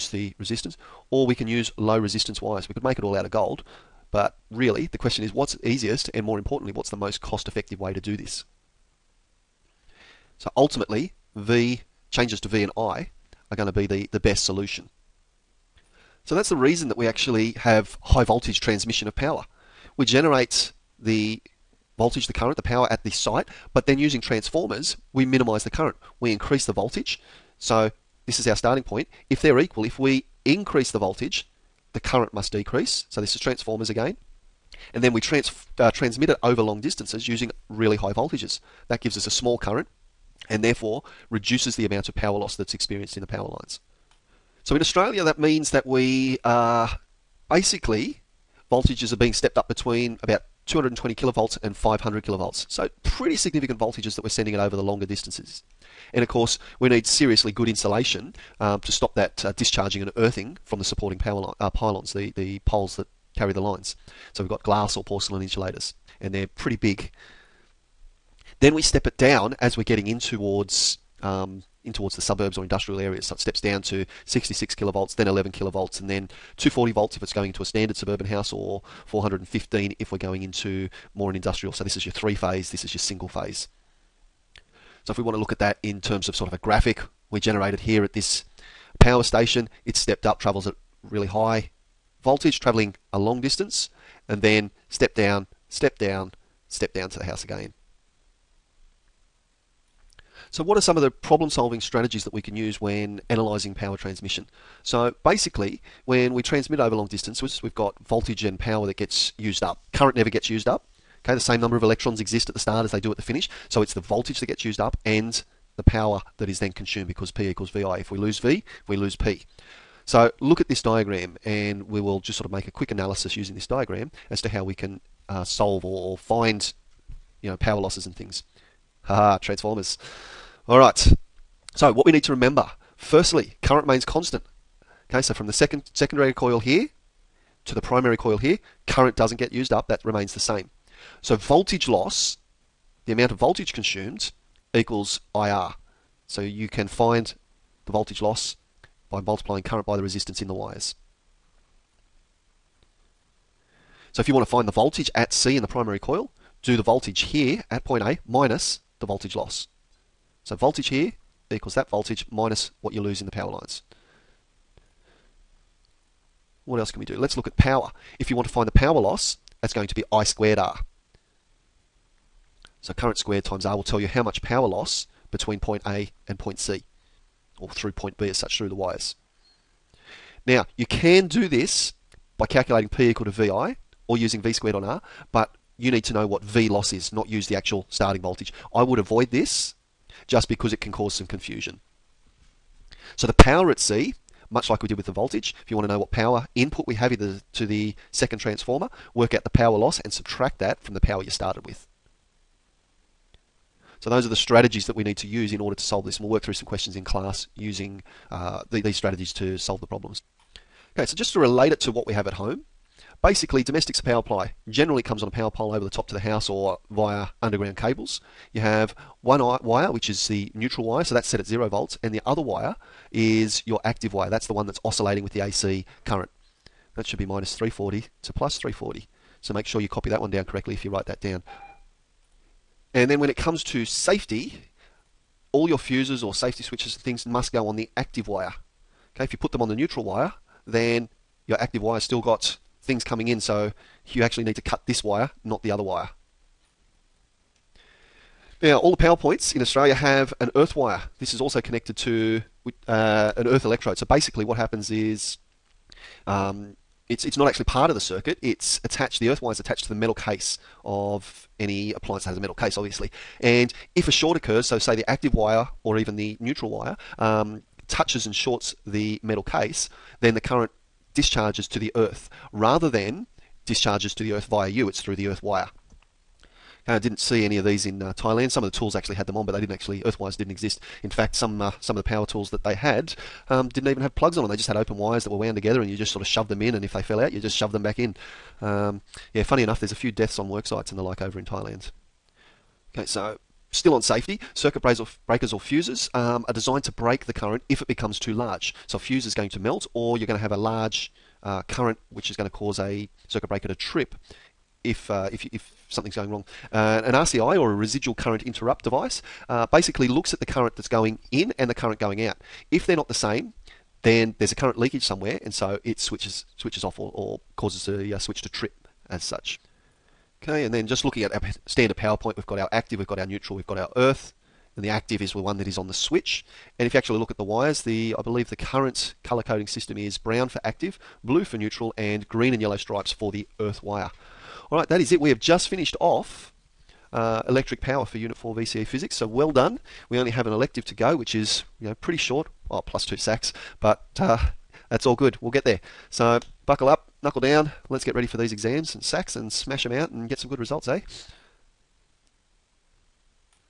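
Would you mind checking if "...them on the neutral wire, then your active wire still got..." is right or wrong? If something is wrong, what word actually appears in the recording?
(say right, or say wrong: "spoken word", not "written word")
right.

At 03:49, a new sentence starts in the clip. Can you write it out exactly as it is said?
So make sure you copy that one down correctly if you write that down.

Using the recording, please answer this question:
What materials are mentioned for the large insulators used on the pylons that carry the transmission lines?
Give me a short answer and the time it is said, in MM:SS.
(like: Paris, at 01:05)
glass or porcelain, at 01:04.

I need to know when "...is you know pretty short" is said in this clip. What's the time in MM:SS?
05:41.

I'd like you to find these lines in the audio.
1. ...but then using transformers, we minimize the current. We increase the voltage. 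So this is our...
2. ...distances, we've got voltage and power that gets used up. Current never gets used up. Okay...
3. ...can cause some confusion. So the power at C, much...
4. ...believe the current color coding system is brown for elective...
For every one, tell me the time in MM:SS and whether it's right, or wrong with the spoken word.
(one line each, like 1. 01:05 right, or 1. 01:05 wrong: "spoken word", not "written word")
1. 00:23 right
2. 01:47 right
3. 03:10 right
4. 05:28 wrong: "active", not "elective".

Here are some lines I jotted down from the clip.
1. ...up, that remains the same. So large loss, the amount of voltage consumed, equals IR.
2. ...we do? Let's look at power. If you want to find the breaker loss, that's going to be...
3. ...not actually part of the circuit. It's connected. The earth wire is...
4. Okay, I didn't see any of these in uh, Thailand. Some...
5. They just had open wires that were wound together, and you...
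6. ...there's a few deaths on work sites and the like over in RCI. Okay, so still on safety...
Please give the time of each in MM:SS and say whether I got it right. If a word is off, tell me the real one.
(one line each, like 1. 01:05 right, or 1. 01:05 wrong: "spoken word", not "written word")
1. 02:19 wrong: "voltage", not "large"
2. 02:47 wrong: "power", not "breaker"
3. 04:17 wrong: "attached", not "connected"
4. 04:36 right
5. 04:44 right
6. 04:49 wrong: "Thailand", not "RCI".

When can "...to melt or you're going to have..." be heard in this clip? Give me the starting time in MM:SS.
04:59.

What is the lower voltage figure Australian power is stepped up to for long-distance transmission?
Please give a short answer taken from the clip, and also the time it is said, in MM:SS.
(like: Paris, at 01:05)
220 kilovolts, at 00:50.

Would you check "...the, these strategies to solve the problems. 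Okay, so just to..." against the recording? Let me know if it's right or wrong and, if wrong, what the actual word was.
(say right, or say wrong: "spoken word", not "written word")
right.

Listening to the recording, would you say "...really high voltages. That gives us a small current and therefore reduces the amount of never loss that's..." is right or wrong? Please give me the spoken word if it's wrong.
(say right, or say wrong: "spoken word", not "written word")
wrong: "power", not "never".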